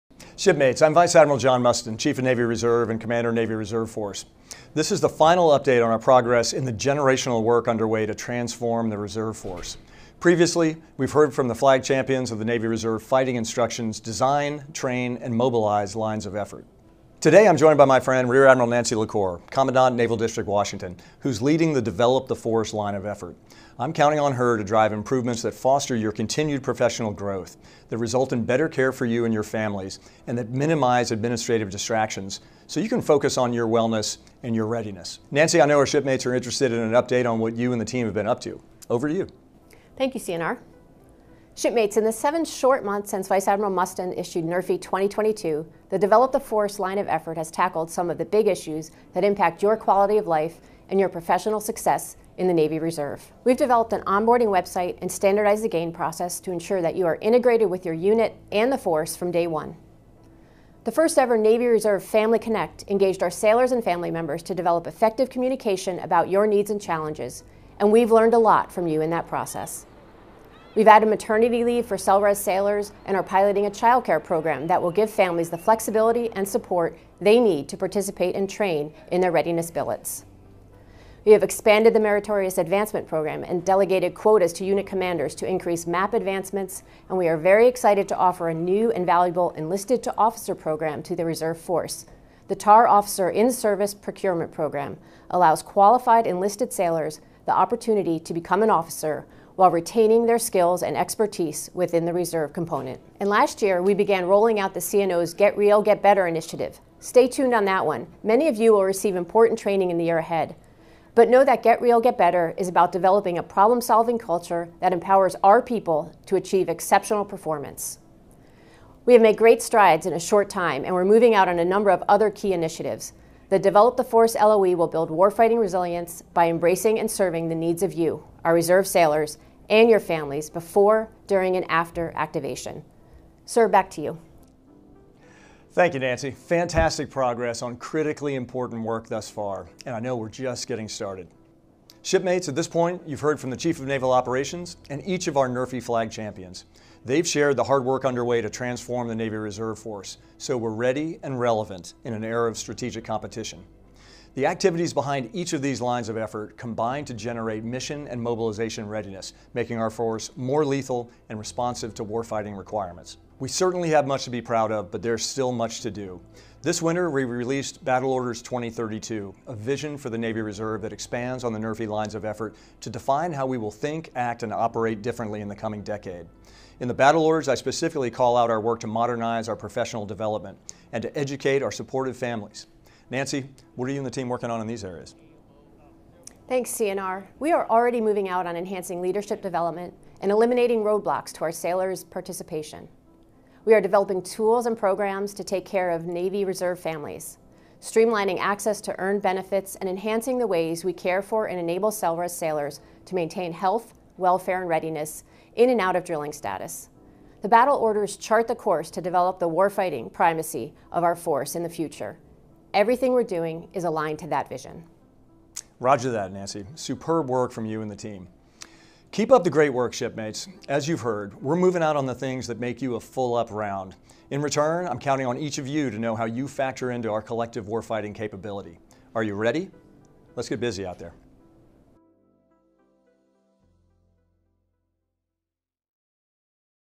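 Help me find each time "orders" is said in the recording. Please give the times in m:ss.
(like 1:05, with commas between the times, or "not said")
2:48, 2:57, 3:27.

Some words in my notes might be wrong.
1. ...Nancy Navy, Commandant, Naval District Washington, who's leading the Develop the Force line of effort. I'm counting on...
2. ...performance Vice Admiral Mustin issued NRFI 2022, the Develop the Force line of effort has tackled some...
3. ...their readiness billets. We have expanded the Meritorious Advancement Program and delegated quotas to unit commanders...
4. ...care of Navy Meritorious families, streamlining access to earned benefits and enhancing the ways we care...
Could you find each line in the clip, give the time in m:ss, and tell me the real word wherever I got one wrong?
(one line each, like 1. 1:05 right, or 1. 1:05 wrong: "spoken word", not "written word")
1. 0:18 wrong: "Lacore", not "Navy"
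2. 0:43 wrong: "since", not "performance"
3. 1:19 right
4. 3:15 wrong: "Reserve", not "Meritorious".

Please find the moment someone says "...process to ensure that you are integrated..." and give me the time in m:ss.
0:55.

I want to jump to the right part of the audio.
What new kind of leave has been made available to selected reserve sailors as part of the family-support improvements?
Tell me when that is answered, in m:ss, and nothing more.
1:11.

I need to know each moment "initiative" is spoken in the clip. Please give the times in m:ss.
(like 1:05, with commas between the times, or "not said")
1:46, 2:02.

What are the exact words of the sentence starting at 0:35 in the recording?
Nancy, I know our shipmates are interested in an update on what you and the team have been up to.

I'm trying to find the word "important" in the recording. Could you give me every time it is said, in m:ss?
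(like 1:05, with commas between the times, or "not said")
1:49, 2:18.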